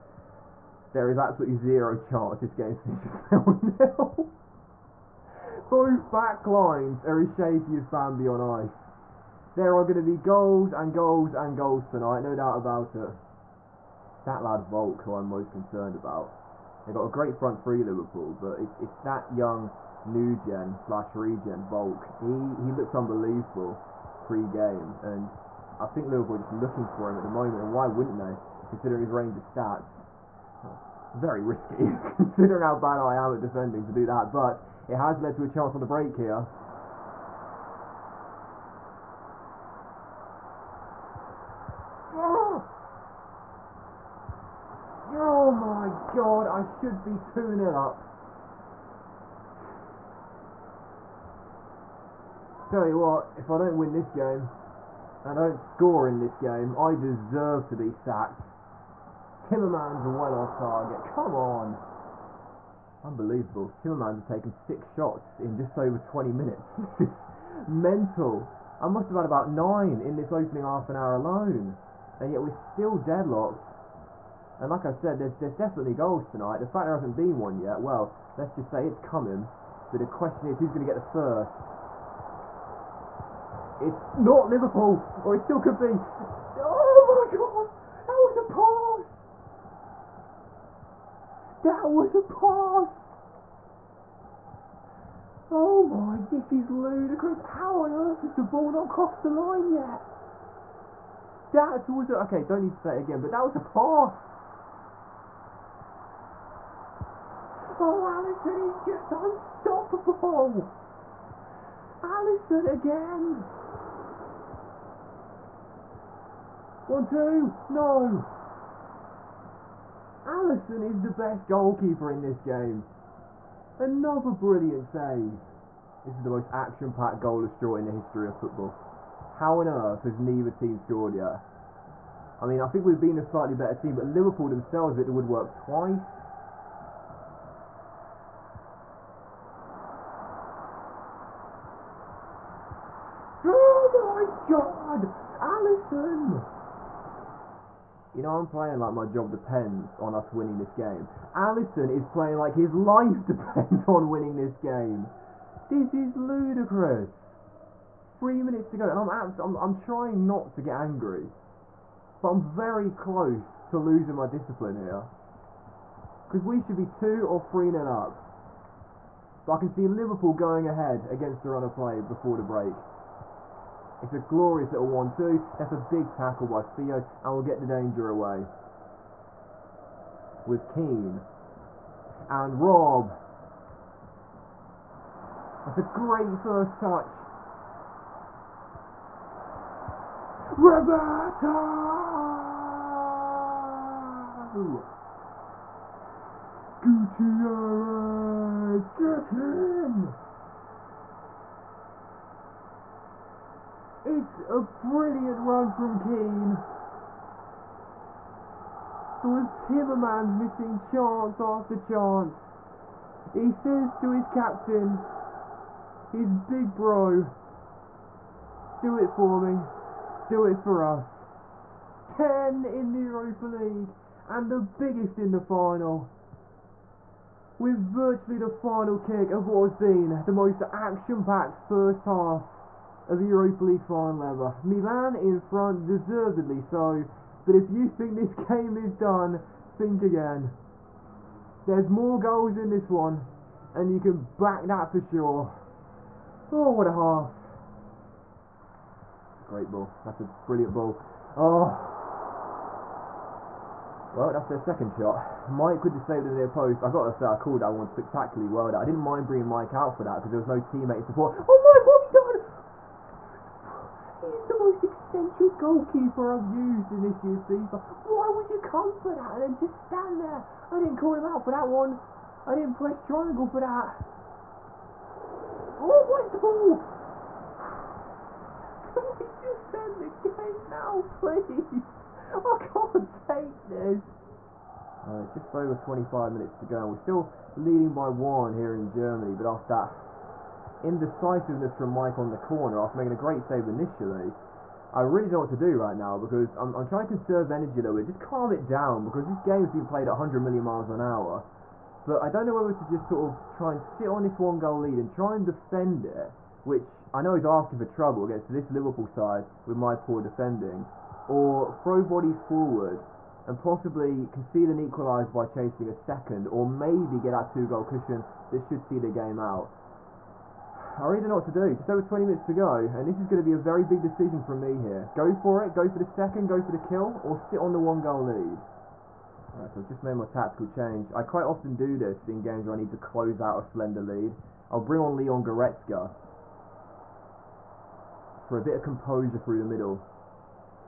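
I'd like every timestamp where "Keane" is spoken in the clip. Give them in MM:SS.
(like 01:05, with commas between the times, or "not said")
03:00, 03:25.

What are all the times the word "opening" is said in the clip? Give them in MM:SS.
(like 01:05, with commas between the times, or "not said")
01:10.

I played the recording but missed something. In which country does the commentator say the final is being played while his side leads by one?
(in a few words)
Germany.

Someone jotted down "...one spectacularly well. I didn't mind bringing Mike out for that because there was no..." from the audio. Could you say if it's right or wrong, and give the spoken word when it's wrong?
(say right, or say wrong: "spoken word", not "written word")
right.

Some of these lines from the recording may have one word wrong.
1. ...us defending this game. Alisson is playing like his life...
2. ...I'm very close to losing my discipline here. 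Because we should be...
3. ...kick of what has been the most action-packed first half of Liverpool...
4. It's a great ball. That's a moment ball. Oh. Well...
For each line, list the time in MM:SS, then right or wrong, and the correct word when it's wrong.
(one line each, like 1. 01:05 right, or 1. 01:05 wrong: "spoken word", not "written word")
1. 02:30 wrong: "winning", not "defending"
2. 02:42 right
3. 03:48 wrong: "Europa", not "Liverpool"
4. 04:09 wrong: "brilliant", not "moment".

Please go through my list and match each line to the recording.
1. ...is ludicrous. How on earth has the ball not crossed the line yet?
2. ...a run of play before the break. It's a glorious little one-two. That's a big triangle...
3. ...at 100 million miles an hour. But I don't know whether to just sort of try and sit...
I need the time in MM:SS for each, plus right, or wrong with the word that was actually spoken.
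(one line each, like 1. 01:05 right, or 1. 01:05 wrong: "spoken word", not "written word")
1. 01:36 right
2. 02:51 wrong: "tackle", not "triangle"
3. 05:00 right.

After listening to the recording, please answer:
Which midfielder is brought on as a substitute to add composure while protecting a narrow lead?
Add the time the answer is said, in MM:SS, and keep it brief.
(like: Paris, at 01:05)
Leon Goretzka, at 05:35.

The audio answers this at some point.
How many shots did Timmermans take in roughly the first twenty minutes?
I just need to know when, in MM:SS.
01:04.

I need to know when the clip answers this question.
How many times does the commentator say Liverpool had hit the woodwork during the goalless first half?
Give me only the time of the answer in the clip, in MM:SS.
02:15.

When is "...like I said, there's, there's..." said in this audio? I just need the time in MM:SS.
01:14.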